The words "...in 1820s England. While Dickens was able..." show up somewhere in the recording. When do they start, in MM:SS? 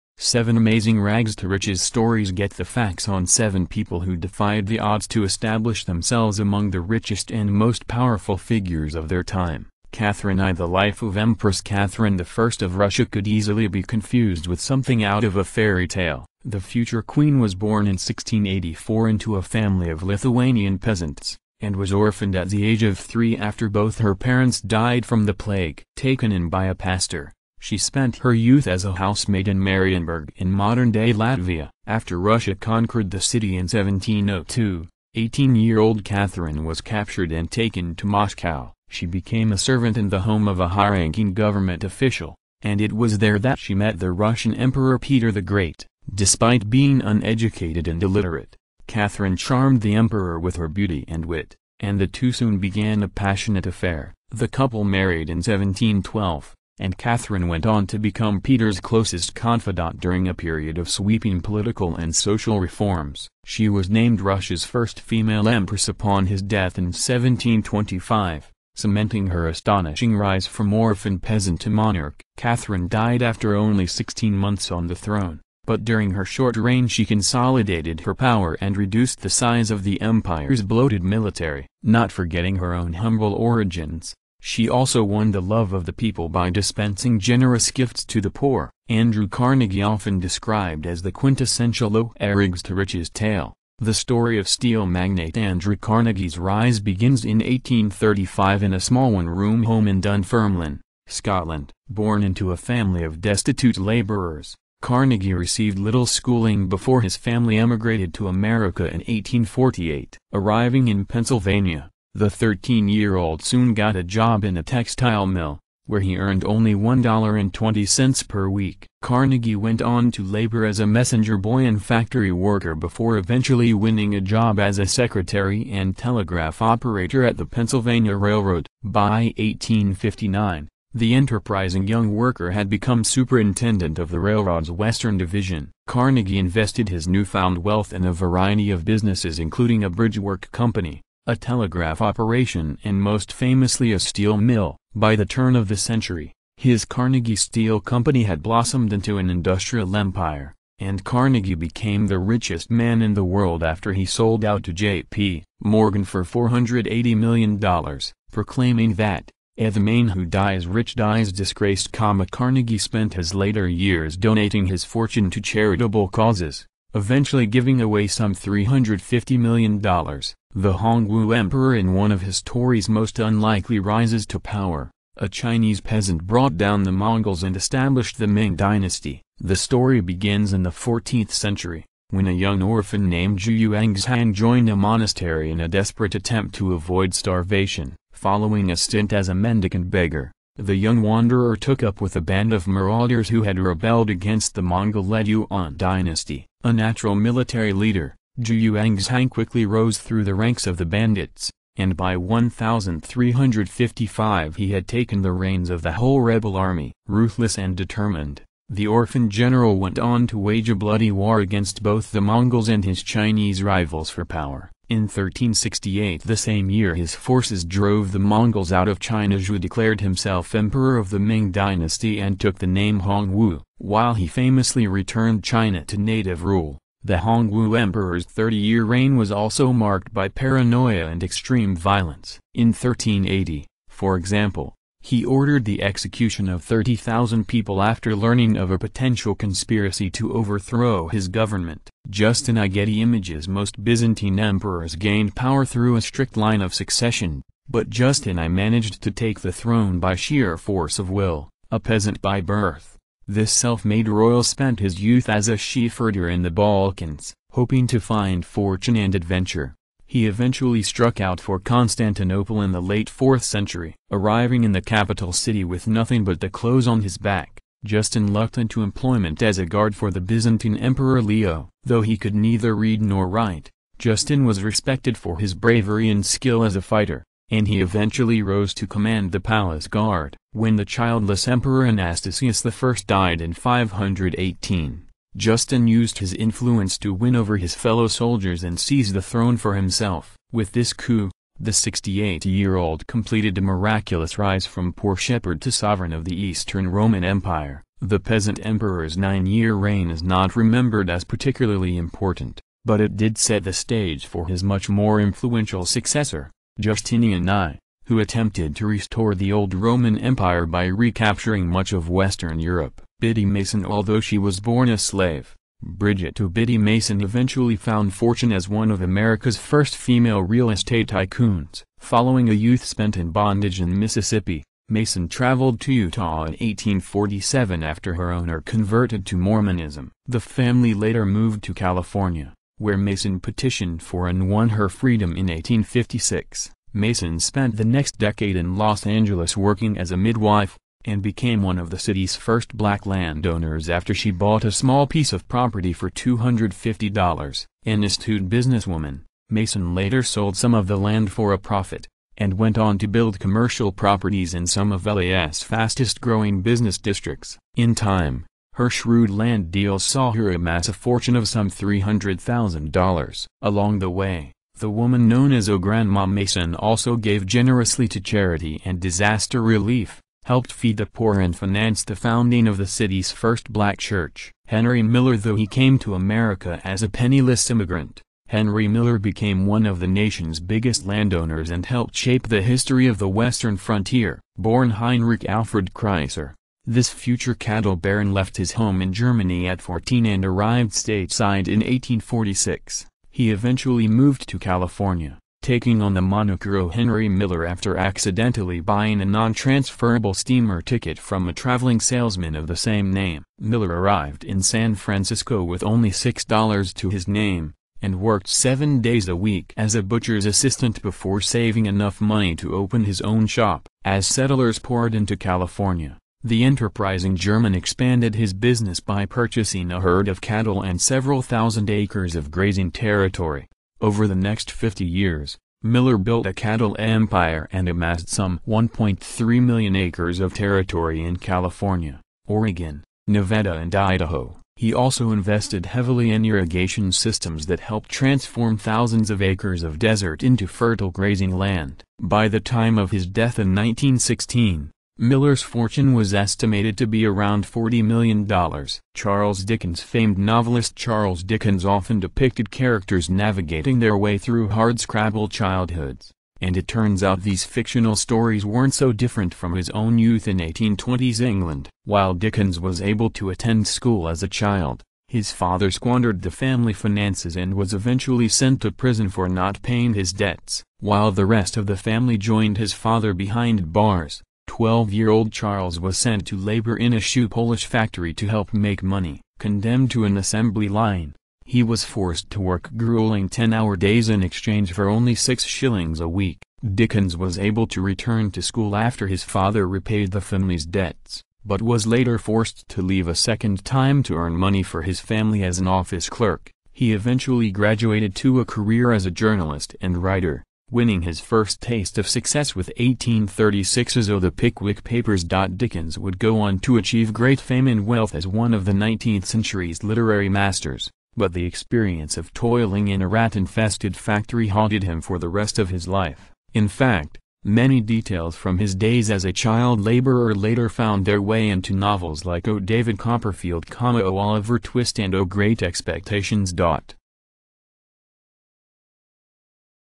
07:40.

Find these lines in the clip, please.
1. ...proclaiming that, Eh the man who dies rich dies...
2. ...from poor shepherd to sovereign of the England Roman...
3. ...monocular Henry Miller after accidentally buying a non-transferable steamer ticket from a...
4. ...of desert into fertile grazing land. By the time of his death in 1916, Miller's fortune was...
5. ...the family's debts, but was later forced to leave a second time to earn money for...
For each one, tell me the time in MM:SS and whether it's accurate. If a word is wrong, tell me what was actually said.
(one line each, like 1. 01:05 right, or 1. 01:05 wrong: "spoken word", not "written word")
1. 02:38 right
2. 04:54 wrong: "Eastern", not "England"
3. 06:36 right
4. 07:19 right
5. 08:10 right.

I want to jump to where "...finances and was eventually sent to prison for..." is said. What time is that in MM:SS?
07:46.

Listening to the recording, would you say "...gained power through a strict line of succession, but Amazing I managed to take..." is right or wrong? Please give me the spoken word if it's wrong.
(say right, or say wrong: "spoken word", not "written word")
wrong: "Justin", not "Amazing".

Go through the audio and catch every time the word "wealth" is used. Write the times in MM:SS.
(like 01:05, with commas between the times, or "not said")
02:17, 08:28.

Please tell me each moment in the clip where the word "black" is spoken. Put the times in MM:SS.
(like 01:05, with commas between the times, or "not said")
05:42, 06:13.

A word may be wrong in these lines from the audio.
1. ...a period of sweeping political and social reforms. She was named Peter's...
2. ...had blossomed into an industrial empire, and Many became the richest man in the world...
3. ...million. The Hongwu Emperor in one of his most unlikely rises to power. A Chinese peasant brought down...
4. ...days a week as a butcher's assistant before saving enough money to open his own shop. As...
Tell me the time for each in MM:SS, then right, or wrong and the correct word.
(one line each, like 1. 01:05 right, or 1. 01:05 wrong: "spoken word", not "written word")
1. 01:00 wrong: "Russia", not "Peter"
2. 02:28 wrong: "Carnegie", not "Many"
3. 02:49 right
4. 06:49 right.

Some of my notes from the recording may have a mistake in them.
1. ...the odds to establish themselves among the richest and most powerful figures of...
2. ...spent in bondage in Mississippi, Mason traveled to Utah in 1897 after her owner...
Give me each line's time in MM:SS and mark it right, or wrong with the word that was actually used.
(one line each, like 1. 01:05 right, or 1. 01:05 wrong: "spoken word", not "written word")
1. 00:04 right
2. 05:22 wrong: "1847", not "1897".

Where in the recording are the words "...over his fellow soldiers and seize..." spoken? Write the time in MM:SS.
04:47.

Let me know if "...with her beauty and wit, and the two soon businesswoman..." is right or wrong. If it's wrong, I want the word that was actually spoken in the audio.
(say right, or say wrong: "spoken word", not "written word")
wrong: "began", not "businesswoman".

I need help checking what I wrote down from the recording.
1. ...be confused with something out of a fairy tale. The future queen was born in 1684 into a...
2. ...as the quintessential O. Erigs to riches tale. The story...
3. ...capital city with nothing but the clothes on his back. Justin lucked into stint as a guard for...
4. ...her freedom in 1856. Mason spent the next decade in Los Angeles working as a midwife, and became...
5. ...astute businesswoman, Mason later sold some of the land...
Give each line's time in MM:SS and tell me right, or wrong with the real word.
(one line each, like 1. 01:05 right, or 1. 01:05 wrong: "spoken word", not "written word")
1. 00:13 right
2. 01:30 right
3. 04:24 wrong: "employment", not "stint"
4. 05:34 right
5. 05:48 right.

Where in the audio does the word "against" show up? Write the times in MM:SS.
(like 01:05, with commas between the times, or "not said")
03:14, 03:31.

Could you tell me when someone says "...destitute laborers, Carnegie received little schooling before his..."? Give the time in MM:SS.
01:43.